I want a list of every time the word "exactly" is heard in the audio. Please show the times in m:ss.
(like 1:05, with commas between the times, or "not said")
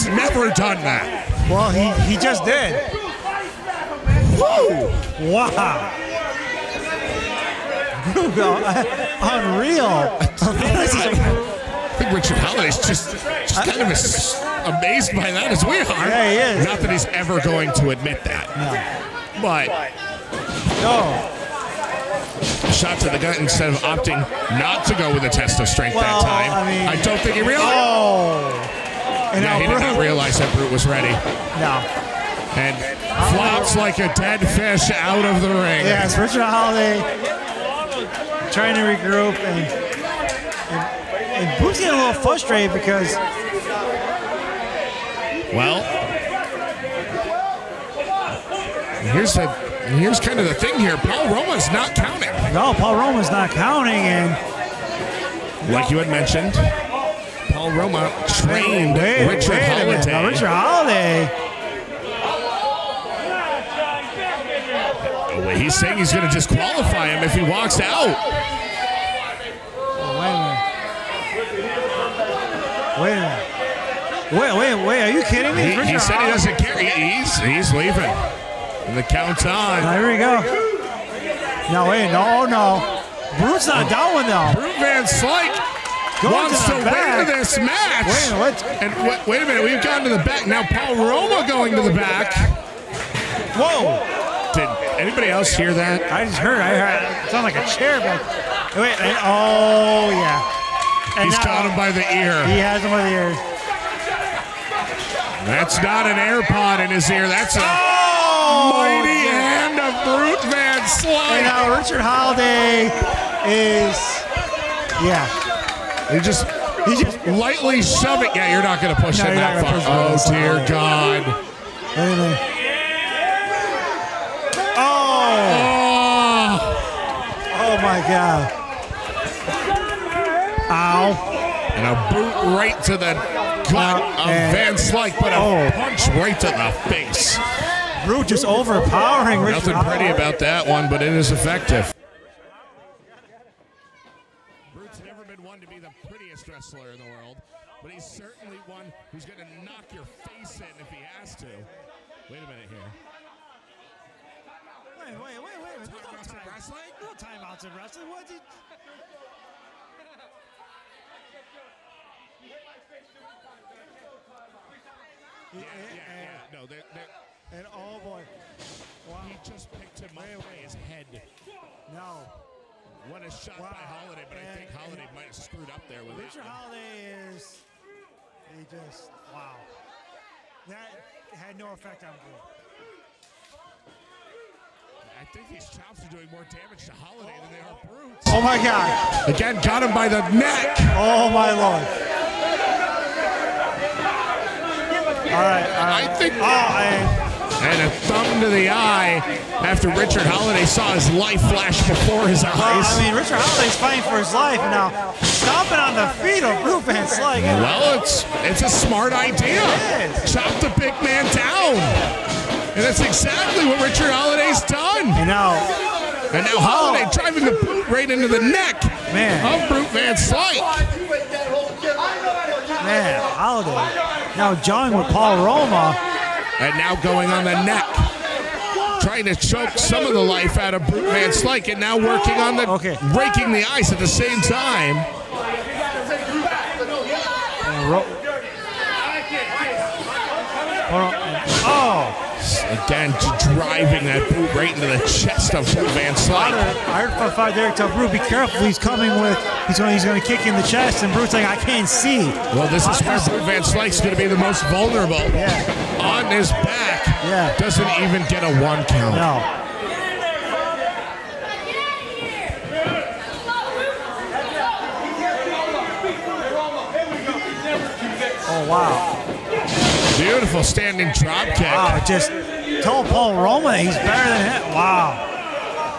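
3:32.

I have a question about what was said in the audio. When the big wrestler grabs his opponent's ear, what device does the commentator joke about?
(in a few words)
AirPod.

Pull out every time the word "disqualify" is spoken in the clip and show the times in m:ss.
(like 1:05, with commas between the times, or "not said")
1:06.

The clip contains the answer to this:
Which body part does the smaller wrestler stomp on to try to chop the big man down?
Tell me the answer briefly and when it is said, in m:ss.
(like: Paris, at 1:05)
Feet, at 3:26.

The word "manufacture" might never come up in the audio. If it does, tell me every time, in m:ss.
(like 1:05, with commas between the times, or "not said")
not said.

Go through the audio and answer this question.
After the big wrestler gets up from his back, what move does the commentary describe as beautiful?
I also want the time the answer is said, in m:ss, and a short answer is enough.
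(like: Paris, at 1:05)
Standing drop kick, at 4:30.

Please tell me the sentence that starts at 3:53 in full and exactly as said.
raking the ice at the same time.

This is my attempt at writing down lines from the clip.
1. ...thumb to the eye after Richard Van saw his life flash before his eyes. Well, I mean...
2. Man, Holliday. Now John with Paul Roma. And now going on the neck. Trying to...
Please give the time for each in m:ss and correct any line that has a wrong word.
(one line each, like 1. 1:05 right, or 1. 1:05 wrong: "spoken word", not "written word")
1. 3:18 wrong: "Holliday", not "Van"
2. 3:42 right.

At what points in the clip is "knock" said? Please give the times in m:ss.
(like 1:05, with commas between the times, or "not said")
2:29.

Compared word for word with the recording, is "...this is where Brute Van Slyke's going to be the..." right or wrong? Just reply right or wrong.
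right.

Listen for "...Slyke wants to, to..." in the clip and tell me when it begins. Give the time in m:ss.
1:25.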